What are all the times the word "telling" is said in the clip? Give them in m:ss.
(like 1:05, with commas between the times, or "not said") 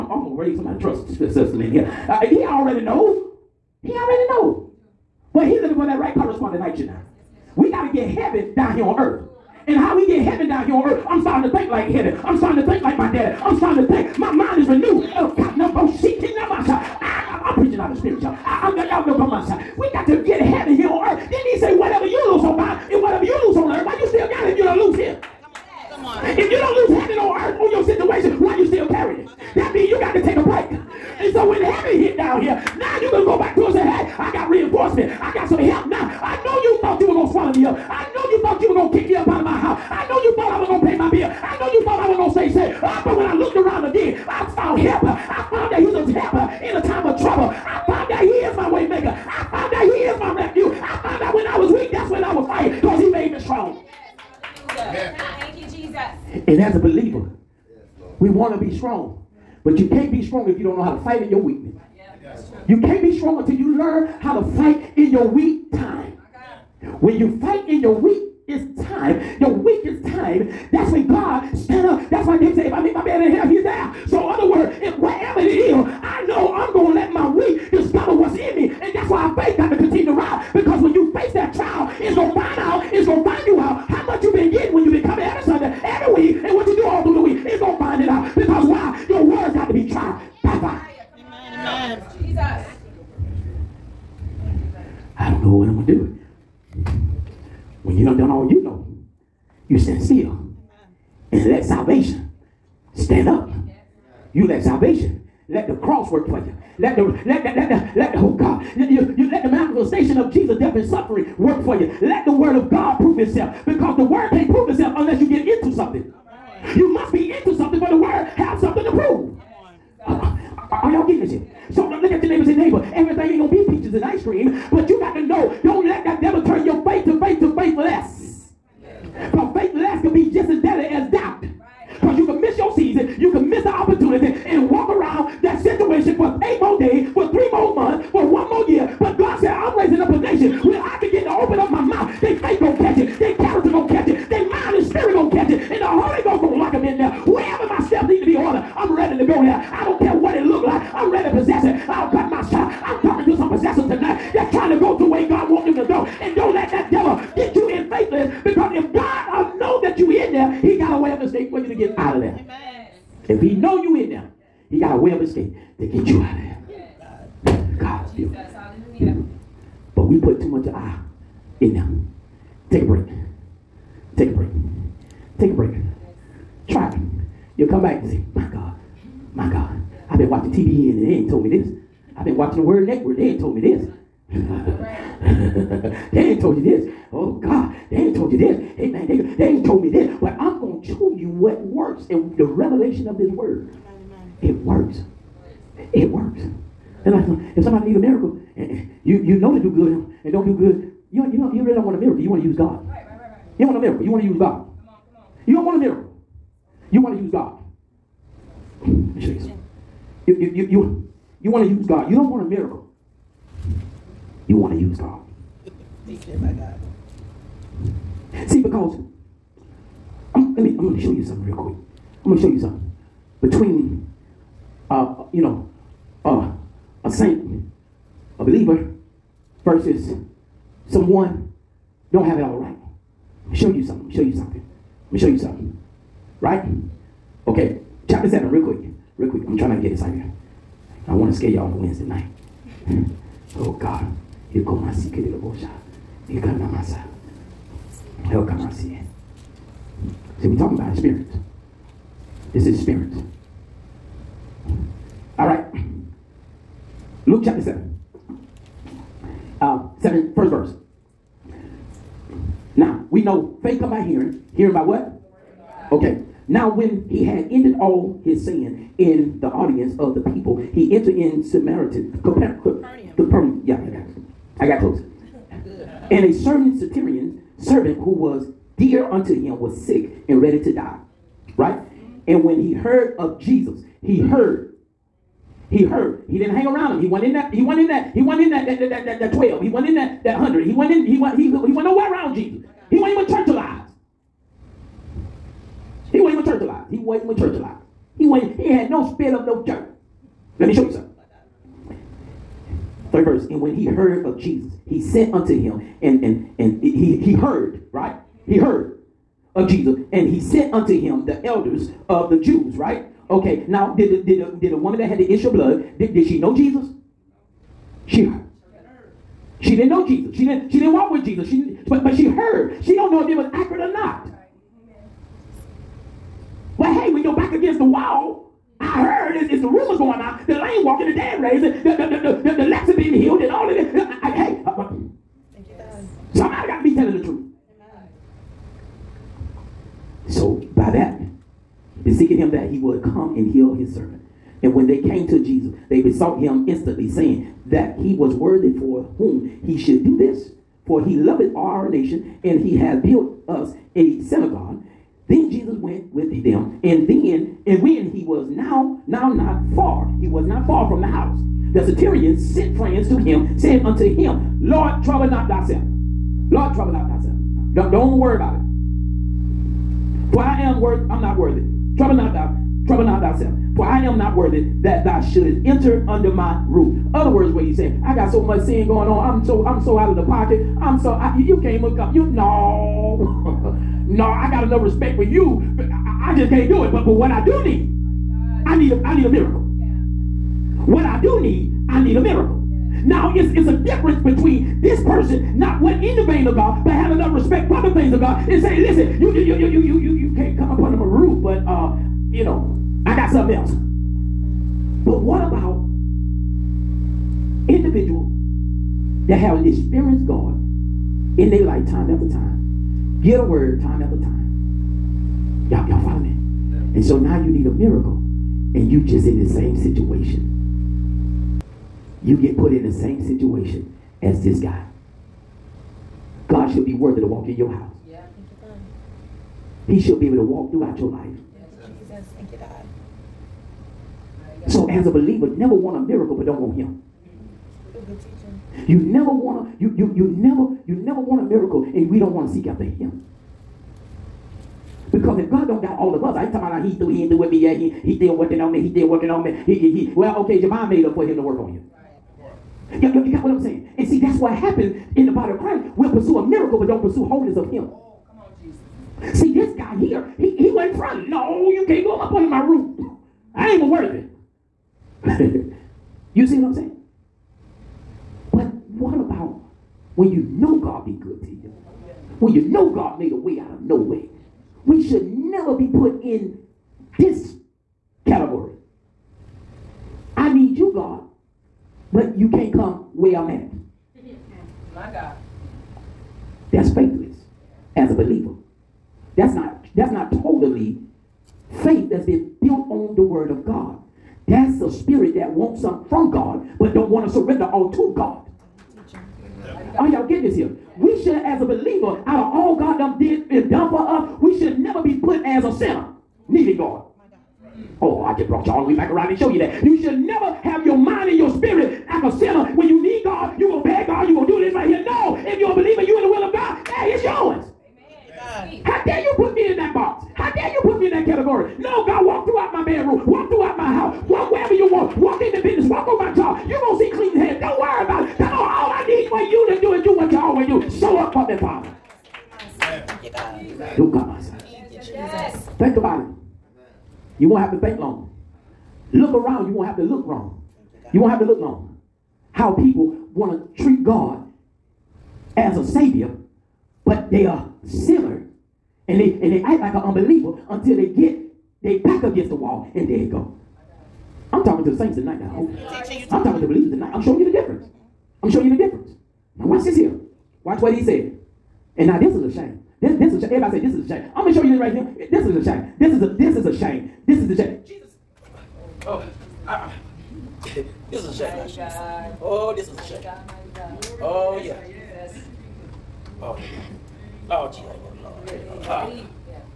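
5:36.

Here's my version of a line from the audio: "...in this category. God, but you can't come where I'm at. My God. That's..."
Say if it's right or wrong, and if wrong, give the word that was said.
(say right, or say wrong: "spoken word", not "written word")
right.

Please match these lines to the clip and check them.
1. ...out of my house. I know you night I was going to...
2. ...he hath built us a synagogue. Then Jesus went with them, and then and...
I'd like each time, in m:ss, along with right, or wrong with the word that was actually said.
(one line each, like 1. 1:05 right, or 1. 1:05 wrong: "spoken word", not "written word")
1. 0:39 wrong: "thought", not "night"
2. 5:52 right.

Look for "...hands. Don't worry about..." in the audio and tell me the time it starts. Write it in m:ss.
8:47.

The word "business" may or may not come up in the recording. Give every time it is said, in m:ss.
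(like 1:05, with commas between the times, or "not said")
8:45.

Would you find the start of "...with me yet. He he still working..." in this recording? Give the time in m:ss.
7:27.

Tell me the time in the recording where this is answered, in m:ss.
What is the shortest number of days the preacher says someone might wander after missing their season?
2:16.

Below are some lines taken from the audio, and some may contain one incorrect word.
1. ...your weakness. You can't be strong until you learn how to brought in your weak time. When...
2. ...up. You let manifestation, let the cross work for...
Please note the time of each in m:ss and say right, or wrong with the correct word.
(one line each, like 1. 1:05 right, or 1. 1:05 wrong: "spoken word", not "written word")
1. 1:01 wrong: "fight", not "brought"
2. 1:43 wrong: "salvation", not "manifestation".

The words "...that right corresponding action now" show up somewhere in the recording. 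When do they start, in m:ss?
0:05.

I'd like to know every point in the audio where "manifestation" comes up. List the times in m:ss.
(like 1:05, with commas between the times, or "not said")
1:49.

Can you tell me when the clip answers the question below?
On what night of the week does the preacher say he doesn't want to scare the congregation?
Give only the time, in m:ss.
4:01.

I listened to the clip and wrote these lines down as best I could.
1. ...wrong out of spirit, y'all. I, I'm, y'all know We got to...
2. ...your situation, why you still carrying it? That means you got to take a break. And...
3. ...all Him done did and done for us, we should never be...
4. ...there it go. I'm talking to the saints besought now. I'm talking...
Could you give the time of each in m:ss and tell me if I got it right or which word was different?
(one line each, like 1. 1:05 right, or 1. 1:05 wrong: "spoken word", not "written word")
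1. 0:17 wrong: "preaching", not "wrong"
2. 0:27 right
3. 8:22 wrong: "God", not "Him"
4. 9:13 wrong: "tonight", not "besought".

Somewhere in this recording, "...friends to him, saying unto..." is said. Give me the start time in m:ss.
6:02.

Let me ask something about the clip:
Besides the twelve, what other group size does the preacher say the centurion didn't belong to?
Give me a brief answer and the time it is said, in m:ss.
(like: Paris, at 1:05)
100, at 4:50.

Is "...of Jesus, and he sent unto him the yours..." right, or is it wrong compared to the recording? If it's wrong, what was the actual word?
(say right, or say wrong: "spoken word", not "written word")
wrong: "elders", not "yours".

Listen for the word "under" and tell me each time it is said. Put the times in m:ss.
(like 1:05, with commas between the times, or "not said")
6:16, 7:42.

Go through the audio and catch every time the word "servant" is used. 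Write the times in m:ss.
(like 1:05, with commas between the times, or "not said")
4:37, 5:43.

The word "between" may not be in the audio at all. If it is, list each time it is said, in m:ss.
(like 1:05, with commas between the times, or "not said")
3:43, 6:34.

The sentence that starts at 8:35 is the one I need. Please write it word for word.
No, if you're a believer, you in the will of God, hey, it's yours.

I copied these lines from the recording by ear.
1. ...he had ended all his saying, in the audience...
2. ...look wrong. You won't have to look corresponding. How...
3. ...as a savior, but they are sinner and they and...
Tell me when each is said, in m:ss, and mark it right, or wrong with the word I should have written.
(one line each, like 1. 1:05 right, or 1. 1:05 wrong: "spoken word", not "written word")
1. 4:27 right
2. 9:00 wrong: "wrong", not "corresponding"
3. 9:05 right.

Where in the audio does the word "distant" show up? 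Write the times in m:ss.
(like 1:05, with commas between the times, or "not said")
not said.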